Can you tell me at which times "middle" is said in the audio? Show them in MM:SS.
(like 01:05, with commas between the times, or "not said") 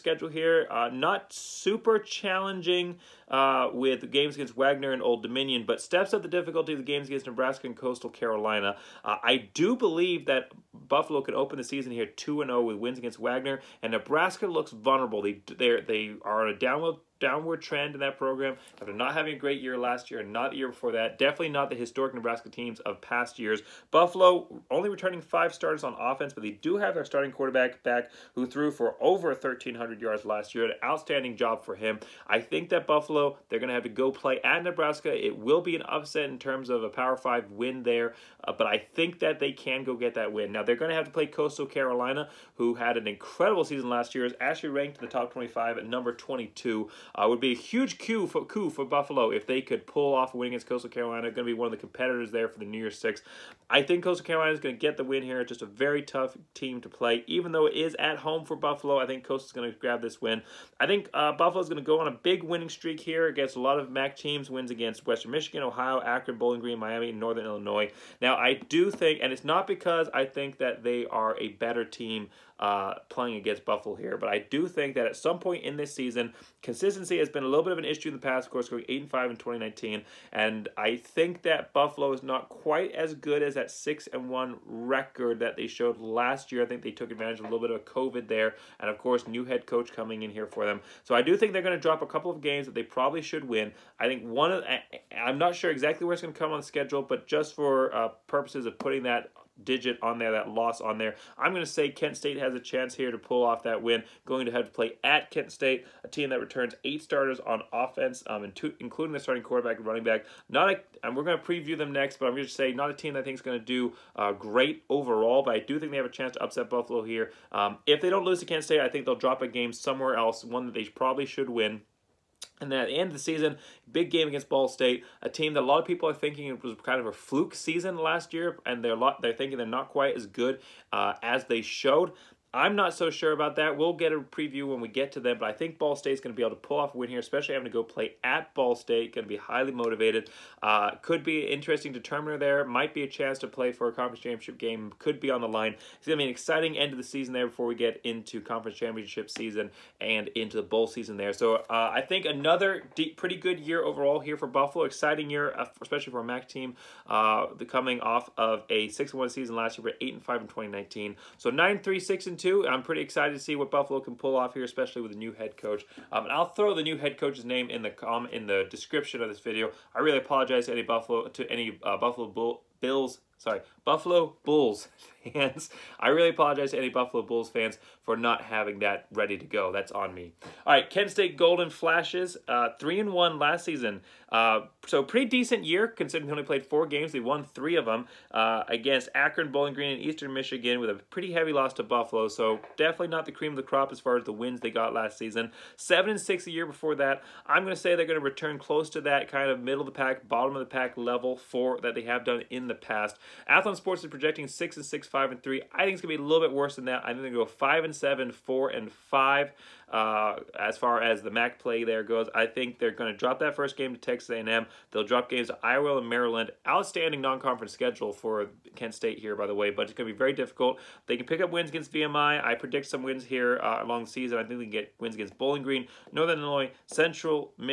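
03:19.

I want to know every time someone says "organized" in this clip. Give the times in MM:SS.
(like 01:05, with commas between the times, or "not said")
not said.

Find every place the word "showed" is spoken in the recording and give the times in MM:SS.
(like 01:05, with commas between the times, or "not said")
01:25, 02:11.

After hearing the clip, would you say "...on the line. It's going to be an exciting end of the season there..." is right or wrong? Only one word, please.
right.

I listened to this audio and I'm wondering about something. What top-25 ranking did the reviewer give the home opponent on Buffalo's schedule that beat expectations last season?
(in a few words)
22.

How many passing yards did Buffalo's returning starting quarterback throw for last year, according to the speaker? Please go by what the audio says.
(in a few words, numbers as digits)
over 1,300.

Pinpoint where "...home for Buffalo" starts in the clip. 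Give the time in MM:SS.
00:58.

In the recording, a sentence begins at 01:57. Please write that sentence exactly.
Um, if they don't lose to Kent State, I think they'll drop a game somewhere else, one that they probably should win.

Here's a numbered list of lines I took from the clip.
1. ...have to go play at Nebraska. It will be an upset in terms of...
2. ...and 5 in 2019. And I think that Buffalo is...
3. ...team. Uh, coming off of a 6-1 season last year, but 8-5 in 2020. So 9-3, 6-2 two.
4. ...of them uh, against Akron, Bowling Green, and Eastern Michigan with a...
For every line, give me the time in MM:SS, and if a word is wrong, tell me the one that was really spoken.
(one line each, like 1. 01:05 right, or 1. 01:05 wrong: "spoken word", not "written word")
1. 00:33 right
2. 01:19 right
3. 02:36 wrong: "2019", not "2020"
4. 03:07 right.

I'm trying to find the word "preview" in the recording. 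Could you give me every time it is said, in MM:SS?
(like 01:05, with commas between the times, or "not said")
01:51, 02:14.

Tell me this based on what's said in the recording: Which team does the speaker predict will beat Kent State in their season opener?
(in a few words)
Texas A&M.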